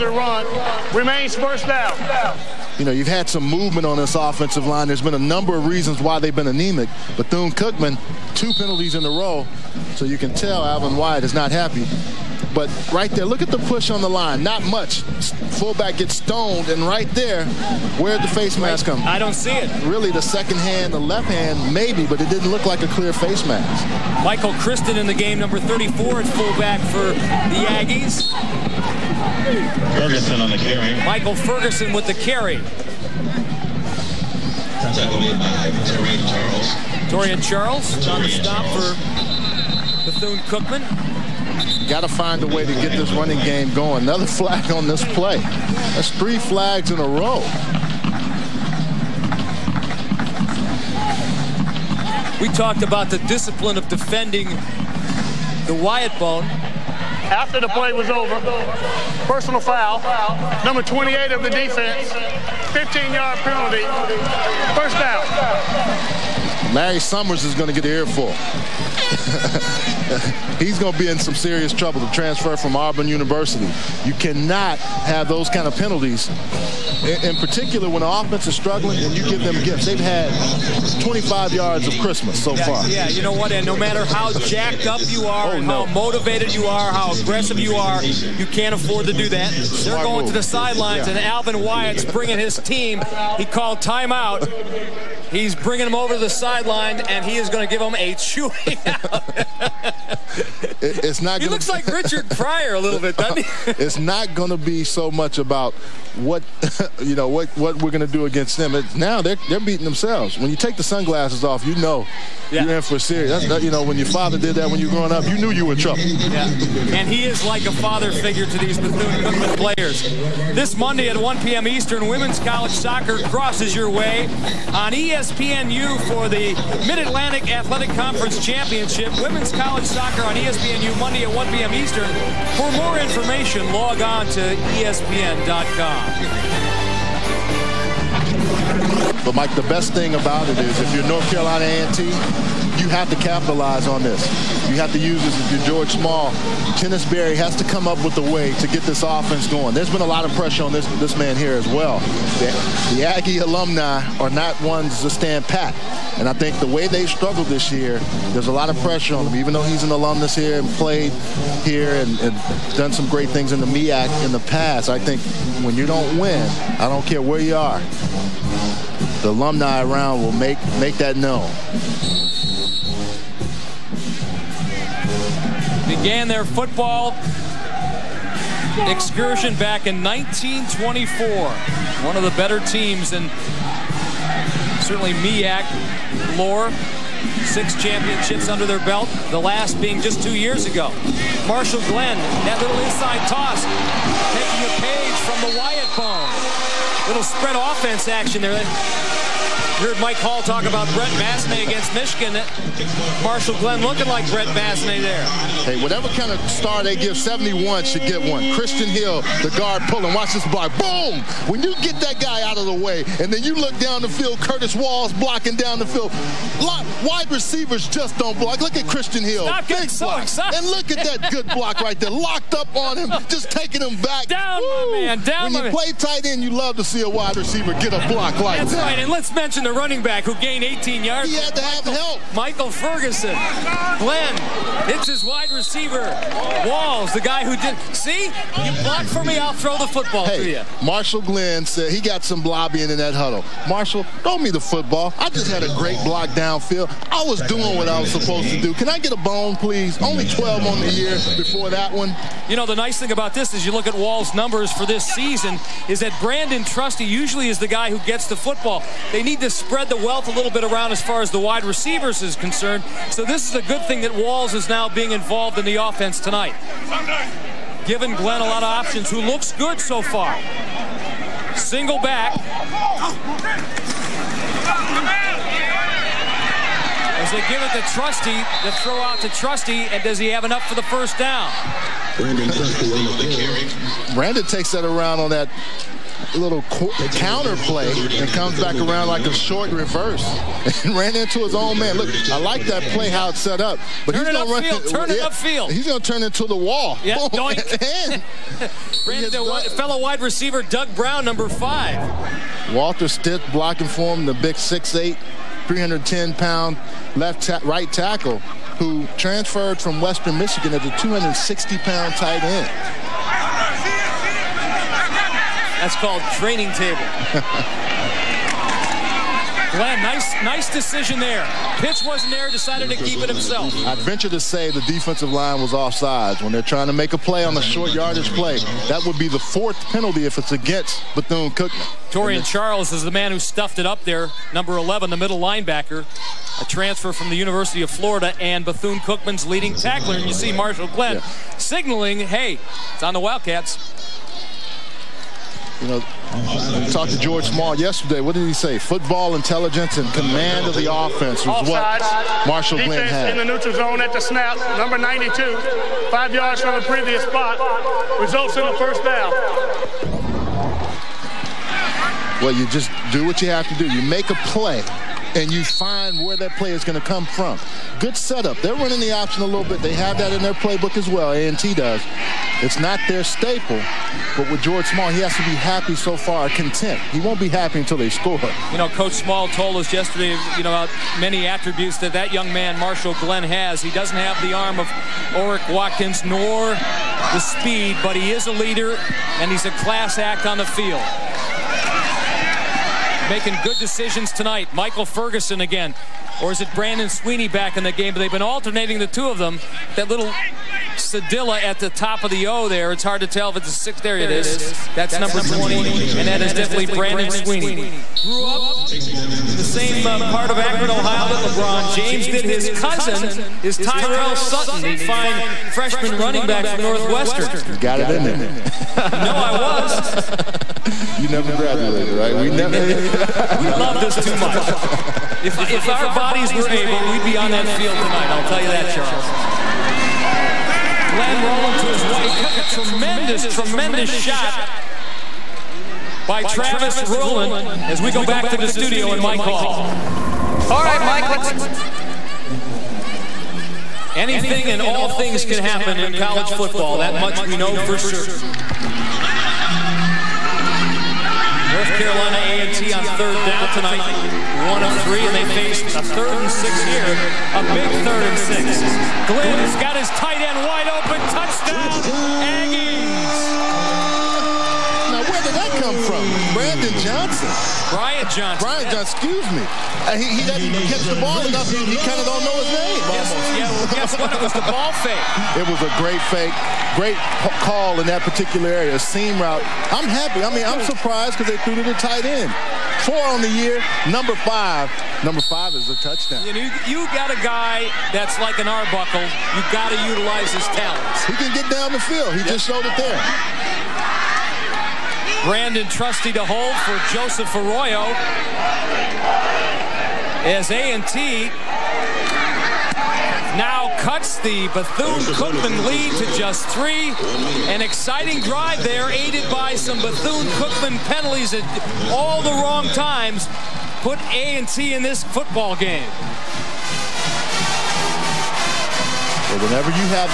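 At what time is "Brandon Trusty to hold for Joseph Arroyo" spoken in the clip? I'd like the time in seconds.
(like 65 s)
495 s.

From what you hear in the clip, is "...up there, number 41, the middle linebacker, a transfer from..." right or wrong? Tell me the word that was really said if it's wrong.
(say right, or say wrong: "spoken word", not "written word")
wrong: "11", not "41".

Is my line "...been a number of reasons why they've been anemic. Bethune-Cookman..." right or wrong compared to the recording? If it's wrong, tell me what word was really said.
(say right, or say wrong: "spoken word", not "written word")
right.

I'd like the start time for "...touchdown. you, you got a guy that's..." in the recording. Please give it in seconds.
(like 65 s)
485 s.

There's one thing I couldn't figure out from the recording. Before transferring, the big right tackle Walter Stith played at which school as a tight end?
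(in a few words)
Western Michigan.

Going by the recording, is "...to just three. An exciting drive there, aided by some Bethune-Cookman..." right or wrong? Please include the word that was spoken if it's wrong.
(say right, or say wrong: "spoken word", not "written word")
right.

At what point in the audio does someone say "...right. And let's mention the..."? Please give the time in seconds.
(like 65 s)
228 s.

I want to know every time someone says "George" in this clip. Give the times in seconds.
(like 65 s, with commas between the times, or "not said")
145 s, 347 s, 374 s.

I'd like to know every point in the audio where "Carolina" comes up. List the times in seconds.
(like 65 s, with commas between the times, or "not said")
141 s, 451 s.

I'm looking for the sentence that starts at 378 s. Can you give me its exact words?
You know, Coach Small told us yesterday, you know, about many attributes that that young man, Marshall Glenn, has.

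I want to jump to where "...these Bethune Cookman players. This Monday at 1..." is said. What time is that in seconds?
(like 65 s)
118 s.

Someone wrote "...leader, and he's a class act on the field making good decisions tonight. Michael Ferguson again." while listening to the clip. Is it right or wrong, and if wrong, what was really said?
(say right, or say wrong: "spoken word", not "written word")
right.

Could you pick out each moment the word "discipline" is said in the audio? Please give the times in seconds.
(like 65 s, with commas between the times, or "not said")
53 s.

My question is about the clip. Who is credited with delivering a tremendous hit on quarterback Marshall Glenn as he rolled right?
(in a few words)
Travis Rowland.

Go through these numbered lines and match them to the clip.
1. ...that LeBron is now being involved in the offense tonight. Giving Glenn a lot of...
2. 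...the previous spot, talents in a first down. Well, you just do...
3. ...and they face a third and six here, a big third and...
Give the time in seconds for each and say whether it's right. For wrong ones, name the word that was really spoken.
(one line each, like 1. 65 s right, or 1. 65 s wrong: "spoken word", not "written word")
1. 264 s wrong: "Walls", not "LeBron"
2. 356 s wrong: "results", not "talents"
3. 455 s right.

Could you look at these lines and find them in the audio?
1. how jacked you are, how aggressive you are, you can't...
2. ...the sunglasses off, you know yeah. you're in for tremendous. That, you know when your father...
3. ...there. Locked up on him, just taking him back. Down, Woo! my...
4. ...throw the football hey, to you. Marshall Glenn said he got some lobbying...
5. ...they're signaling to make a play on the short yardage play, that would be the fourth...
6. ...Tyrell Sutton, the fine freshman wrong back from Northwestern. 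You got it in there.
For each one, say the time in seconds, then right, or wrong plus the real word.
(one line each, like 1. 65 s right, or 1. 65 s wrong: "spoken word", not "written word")
1. 85 s wrong: "motivated", not "jacked"
2. 110 s wrong: "serious", not "tremendous"
3. 221 s right
4. 239 s right
5. 326 s wrong: "trying", not "signaling"
6. 413 s wrong: "running", not "wrong".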